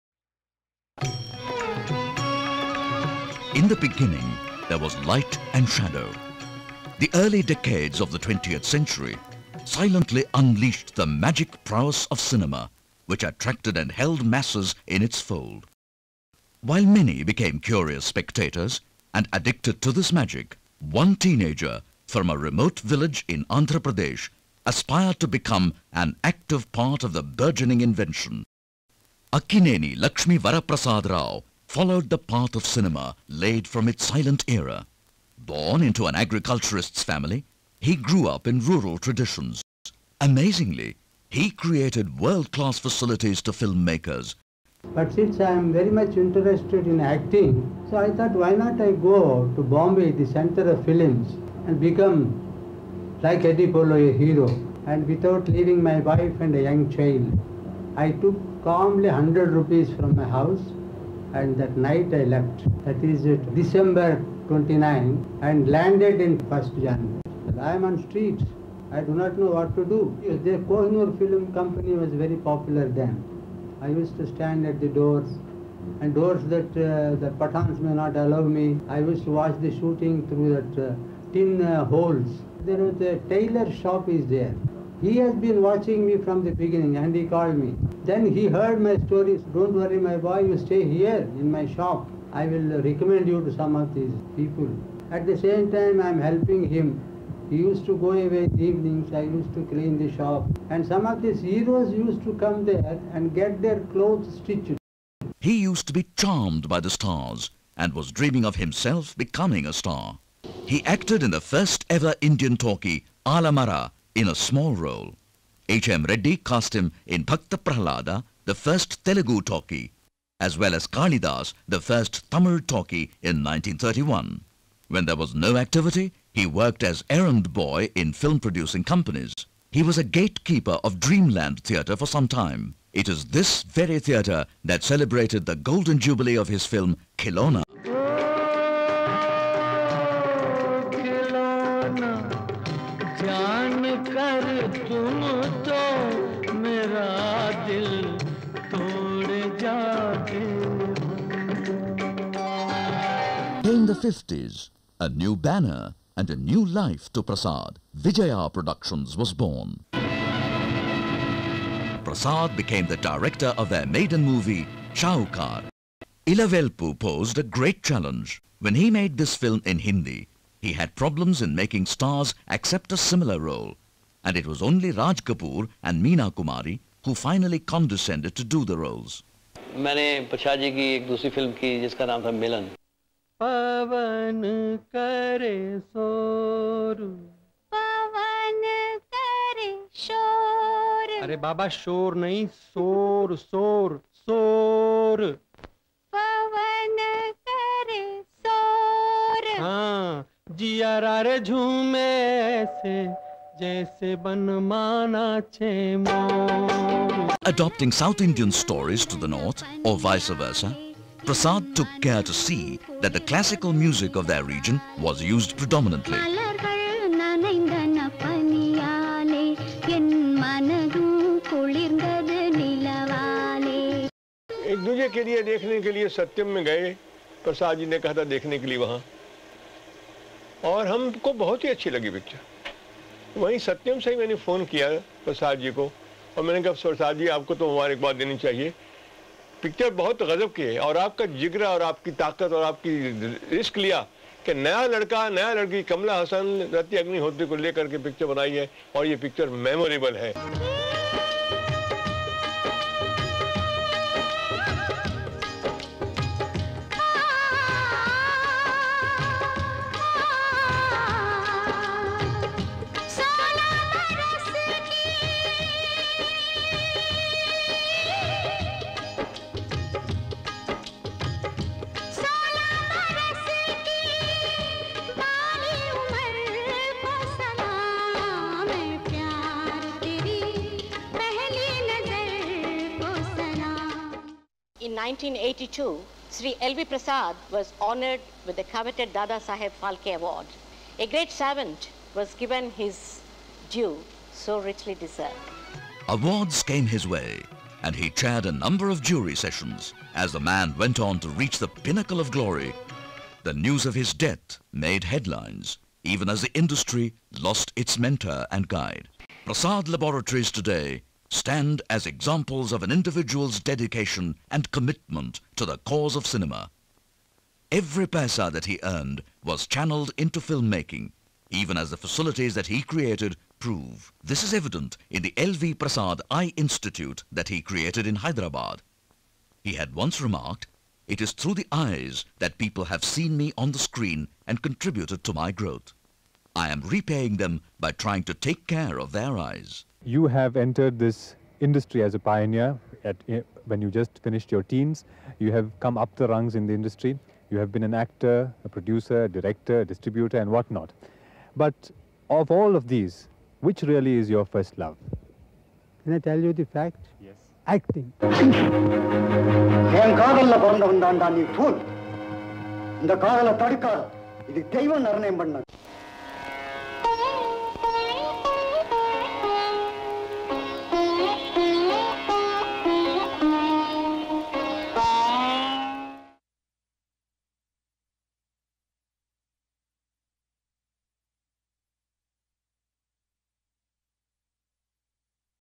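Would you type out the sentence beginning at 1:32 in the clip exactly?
I will recommend you to some of these people.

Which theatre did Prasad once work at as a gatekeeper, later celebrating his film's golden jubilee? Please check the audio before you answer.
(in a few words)
Dreamland Theatre.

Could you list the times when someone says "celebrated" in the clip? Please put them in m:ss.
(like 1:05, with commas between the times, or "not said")
2:14.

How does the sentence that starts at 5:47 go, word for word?
You have been an actor, a producer, a director, a distributor, and whatnot.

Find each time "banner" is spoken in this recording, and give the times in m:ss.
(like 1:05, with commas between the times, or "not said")
2:35.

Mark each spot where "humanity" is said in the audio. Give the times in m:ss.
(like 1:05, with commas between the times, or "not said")
not said.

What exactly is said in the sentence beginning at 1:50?
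He acted in the first ever Indian talkie, Alam Ara, in a small role.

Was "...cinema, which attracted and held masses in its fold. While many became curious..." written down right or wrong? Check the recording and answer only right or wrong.
right.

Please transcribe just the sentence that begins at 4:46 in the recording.
Prasad was honored with the coveted Dada Saheb Phalke Award.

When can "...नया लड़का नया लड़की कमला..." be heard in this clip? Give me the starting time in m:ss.
4:04.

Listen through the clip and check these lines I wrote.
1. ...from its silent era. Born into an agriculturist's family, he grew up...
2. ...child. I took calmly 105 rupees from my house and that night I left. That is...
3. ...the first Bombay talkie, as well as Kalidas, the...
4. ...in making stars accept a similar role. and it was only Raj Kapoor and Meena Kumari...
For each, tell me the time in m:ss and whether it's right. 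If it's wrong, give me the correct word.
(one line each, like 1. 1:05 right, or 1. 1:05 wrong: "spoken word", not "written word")
1. 0:33 right
2. 0:56 wrong: "100", not "105"
3. 1:58 wrong: "Telugu", not "Bombay"
4. 2:51 right.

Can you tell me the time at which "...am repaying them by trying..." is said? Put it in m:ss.
5:36.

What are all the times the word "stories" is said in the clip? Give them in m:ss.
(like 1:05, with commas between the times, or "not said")
1:29, 3:28.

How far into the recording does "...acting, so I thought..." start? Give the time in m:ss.
0:46.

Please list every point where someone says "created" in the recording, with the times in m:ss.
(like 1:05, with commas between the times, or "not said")
0:41, 5:22, 5:27.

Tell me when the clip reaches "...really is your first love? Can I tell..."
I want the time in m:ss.
5:53.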